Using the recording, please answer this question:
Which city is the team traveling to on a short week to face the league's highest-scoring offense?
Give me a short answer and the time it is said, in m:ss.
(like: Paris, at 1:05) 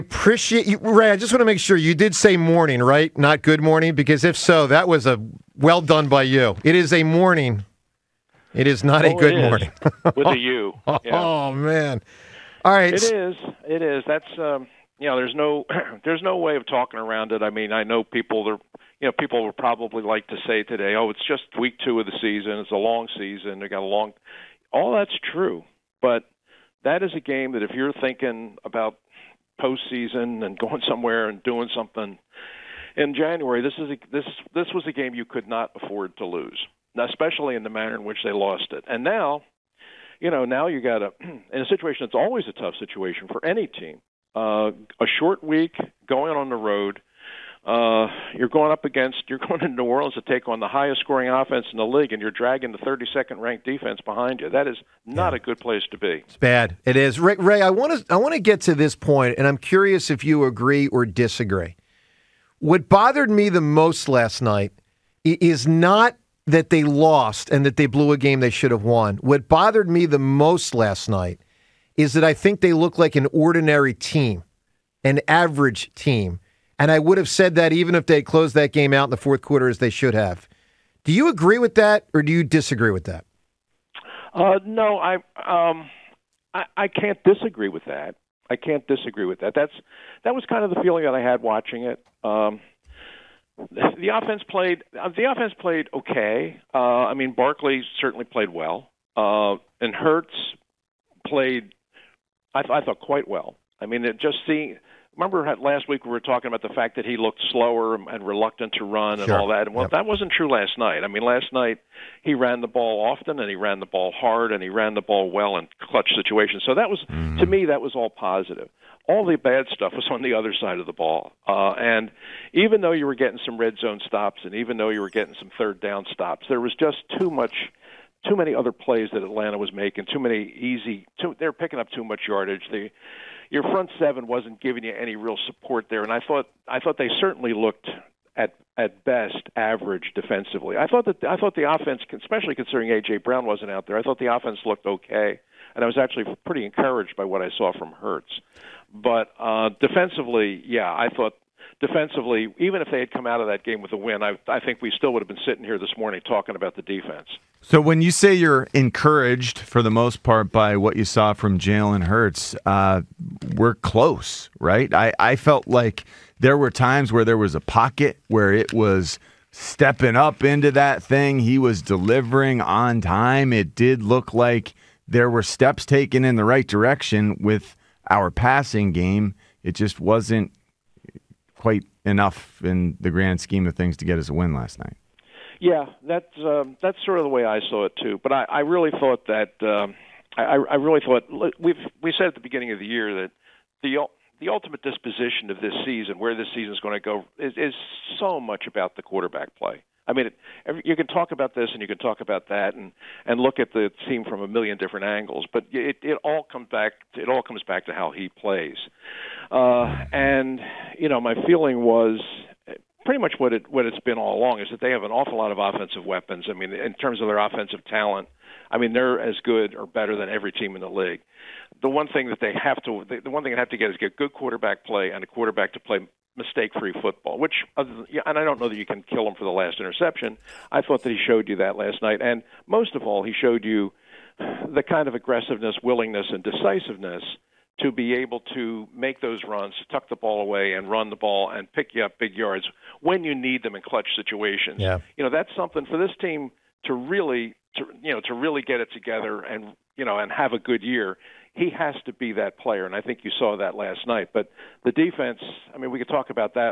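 New Orleans, at 0:49.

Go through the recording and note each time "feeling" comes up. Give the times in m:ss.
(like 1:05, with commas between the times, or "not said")
1:30, 3:31.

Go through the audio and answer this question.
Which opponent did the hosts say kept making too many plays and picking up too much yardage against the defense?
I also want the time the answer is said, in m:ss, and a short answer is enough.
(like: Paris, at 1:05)
Atlanta, at 2:09.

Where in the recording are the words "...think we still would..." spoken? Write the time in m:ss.
2:34.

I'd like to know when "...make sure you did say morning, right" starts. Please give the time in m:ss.
0:01.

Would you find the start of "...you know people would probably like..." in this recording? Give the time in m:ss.
0:18.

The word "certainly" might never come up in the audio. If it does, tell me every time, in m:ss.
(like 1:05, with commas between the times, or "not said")
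1:37, 2:17.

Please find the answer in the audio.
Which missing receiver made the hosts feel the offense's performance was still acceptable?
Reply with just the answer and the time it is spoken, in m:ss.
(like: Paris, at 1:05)
AJ Brown, at 2:22.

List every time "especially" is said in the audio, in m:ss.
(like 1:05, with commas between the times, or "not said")
0:37, 2:22.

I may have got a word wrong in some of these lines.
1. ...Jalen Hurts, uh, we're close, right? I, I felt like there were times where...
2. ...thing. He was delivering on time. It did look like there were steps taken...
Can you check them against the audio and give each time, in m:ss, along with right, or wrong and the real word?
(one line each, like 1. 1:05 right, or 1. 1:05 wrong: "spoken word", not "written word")
1. 2:41 right
2. 2:51 right.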